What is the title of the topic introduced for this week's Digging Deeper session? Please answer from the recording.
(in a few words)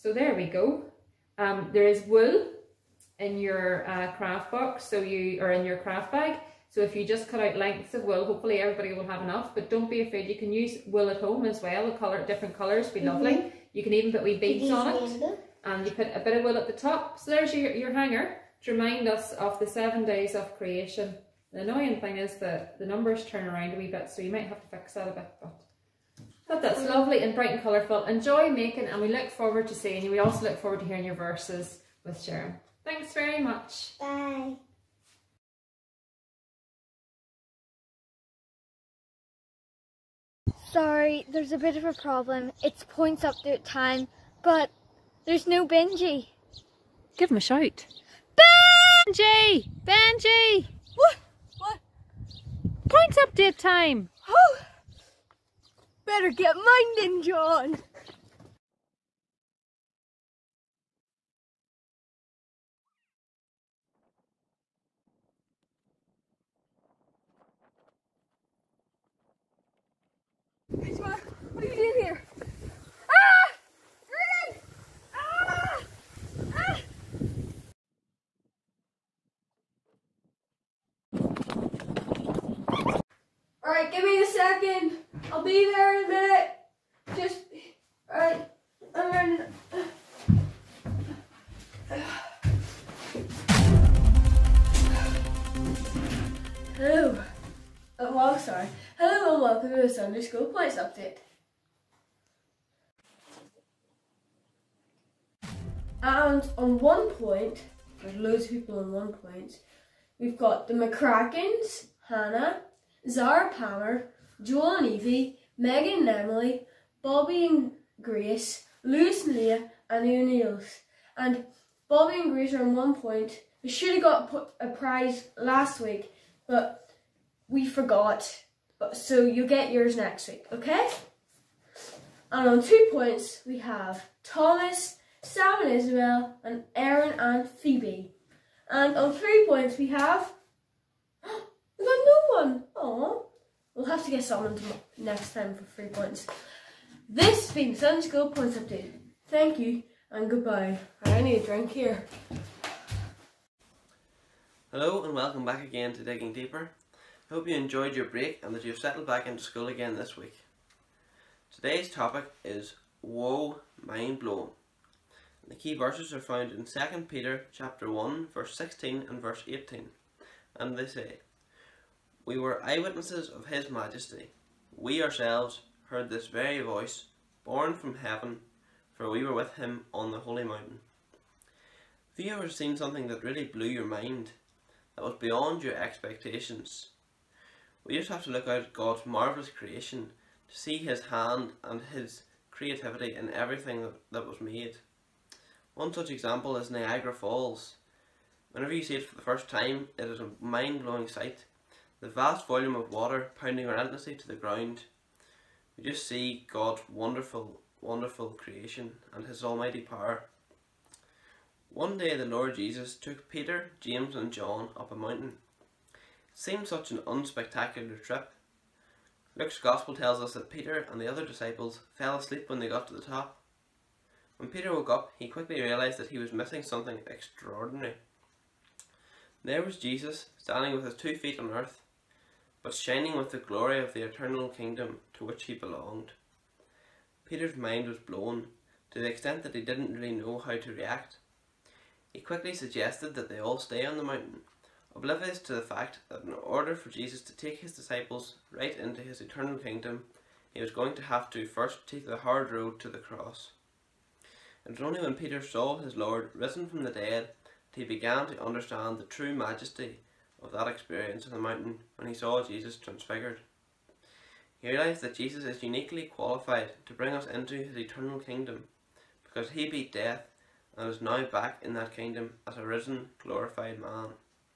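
Woe Mind Blown.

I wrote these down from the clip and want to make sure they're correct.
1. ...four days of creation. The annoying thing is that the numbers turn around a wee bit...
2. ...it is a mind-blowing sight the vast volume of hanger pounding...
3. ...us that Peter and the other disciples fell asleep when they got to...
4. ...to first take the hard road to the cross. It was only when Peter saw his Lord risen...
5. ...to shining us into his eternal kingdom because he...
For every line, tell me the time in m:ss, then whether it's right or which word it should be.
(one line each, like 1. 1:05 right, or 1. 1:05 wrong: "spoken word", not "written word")
1. 0:19 wrong: "seven", not "four"
2. 3:19 wrong: "water", not "hanger"
3. 3:40 right
4. 4:11 right
5. 4:26 wrong: "bring", not "shining".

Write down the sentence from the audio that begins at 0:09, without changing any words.
But don't be afraid, you can use wool at home as well.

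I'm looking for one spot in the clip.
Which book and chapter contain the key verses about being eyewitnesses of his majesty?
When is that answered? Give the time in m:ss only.
2:46.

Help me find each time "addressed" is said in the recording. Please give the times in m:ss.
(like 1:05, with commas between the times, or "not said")
not said.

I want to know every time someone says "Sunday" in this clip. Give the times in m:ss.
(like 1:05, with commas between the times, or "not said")
1:39, 2:27.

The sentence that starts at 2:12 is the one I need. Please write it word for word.
And on two points, we have Thomas, Sam and Isabel, and Aaron and Phoebe.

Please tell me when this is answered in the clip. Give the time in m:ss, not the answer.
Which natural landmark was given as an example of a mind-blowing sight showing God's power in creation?
3:16.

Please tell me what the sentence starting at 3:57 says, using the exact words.
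Peter's mind was blown to the extent that he didn't really know how to react.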